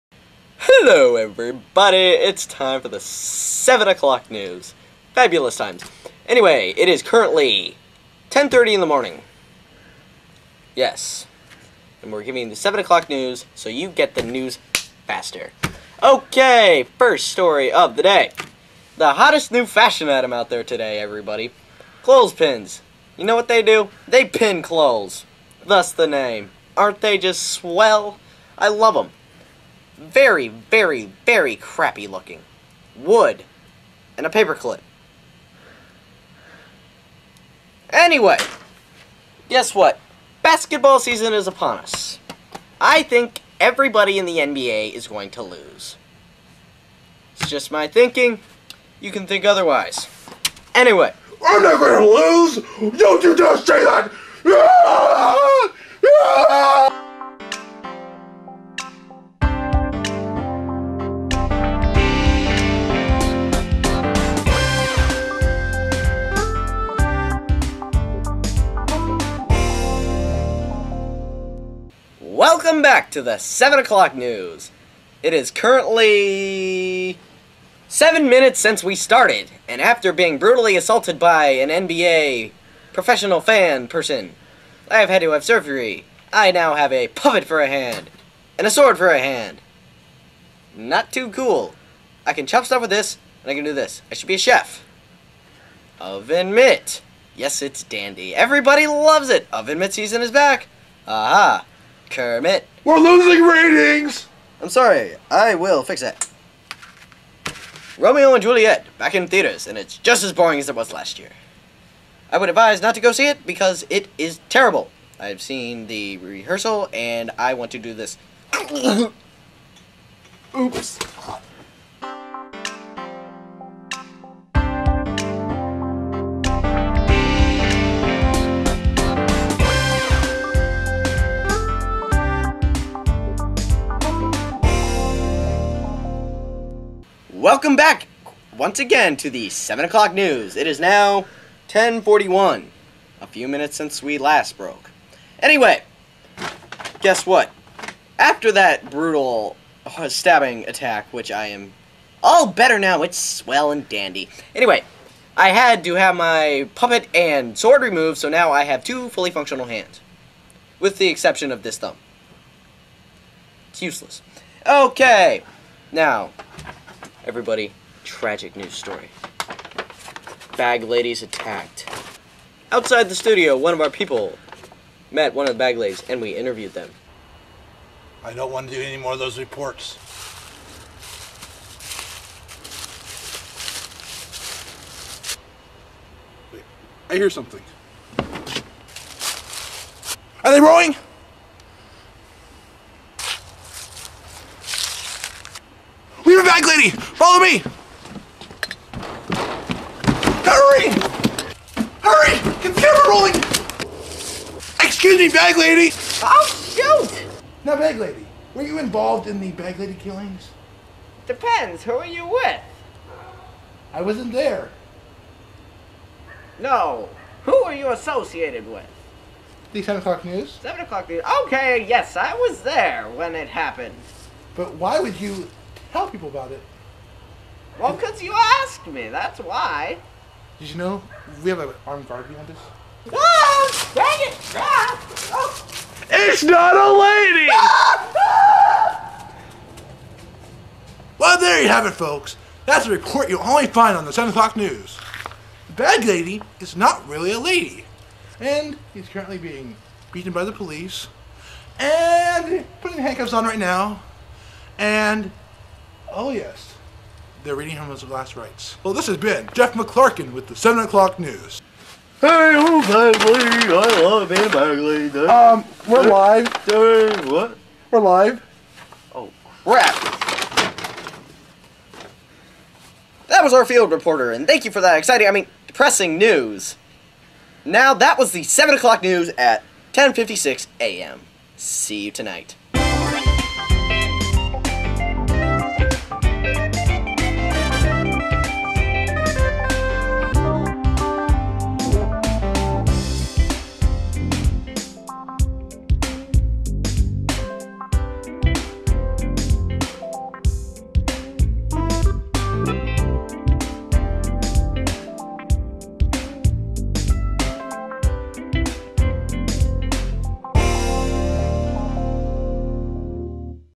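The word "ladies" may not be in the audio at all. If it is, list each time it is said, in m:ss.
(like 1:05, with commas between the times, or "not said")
2:50, 2:55.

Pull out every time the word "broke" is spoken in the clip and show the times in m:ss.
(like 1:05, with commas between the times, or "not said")
2:24.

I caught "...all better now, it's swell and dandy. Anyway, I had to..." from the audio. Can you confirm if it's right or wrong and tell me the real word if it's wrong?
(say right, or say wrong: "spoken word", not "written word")
right.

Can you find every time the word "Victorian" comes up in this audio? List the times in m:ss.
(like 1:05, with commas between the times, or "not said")
not said.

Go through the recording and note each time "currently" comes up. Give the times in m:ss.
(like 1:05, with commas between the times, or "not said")
0:07, 1:15, 4:09.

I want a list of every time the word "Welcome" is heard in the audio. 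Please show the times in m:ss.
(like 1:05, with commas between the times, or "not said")
1:12, 2:17.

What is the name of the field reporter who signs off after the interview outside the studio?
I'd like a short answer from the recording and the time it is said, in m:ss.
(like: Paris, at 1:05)
Jeff McClarkin, at 4:19.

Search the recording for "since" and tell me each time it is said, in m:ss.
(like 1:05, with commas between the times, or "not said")
1:18, 2:23.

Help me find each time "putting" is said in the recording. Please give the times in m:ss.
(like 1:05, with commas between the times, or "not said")
4:12.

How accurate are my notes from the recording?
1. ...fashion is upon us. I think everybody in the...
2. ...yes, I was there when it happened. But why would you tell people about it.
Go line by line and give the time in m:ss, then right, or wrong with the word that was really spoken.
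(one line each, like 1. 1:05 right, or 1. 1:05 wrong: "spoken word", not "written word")
1. 0:40 wrong: "season", not "fashion"
2. 3:41 right.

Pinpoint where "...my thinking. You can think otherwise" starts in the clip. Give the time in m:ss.
0:47.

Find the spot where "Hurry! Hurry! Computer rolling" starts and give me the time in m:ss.
3:20.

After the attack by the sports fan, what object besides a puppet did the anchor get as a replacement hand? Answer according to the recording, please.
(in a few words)
A sword.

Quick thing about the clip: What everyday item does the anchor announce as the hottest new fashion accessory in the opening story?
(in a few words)
Clothespins.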